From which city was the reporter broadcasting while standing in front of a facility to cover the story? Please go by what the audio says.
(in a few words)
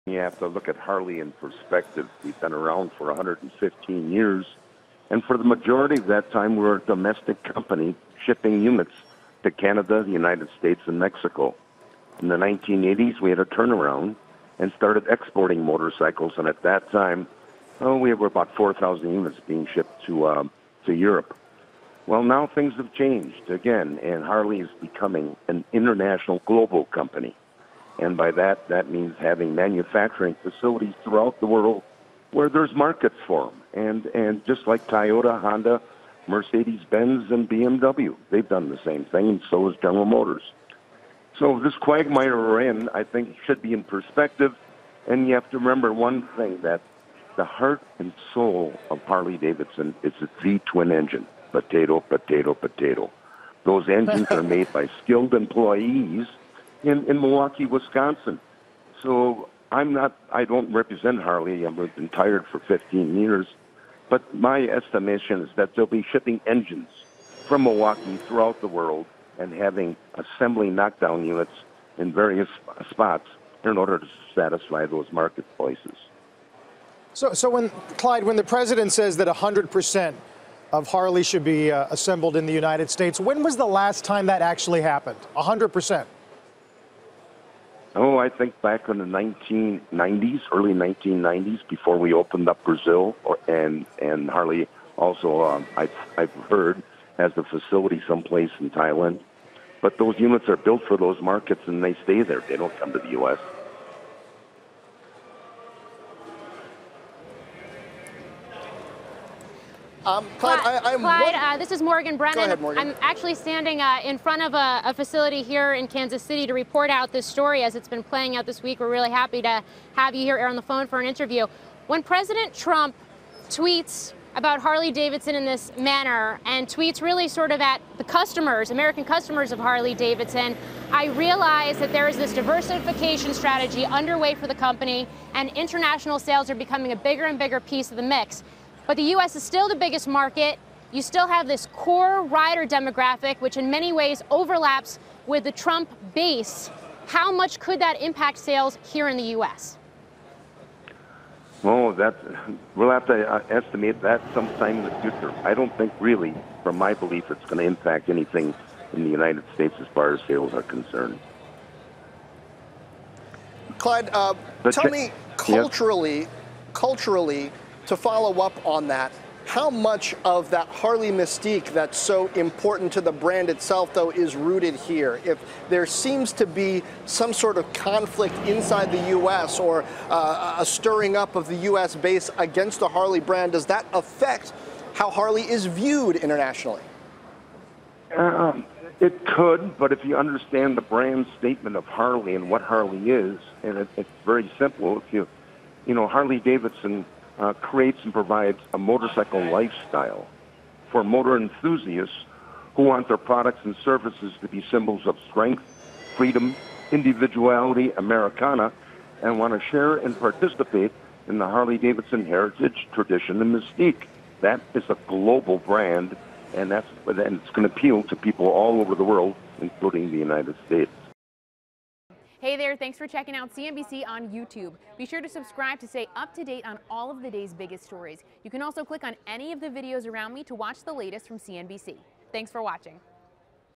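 Kansas City.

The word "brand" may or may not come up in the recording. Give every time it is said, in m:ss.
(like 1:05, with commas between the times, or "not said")
2:53, 3:03, 3:10, 3:35.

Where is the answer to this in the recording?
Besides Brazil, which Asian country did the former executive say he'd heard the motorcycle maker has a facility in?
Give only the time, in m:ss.
1:38.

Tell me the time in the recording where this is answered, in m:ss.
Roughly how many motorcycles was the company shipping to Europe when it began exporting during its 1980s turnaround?
0:18.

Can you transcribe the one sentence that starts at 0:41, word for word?
So this quagmire we're in, I think, should be in perspective.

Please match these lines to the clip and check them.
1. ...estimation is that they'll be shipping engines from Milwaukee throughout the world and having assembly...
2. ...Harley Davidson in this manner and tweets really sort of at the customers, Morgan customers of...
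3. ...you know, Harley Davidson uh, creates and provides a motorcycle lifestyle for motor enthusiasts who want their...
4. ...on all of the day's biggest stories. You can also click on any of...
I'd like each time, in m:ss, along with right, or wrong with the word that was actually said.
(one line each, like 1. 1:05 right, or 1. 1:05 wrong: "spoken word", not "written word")
1. 1:04 right
2. 2:04 wrong: "American", not "Morgan"
3. 3:15 right
4. 3:46 right.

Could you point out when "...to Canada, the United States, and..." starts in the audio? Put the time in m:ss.
0:09.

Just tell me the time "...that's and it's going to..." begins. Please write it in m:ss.
3:36.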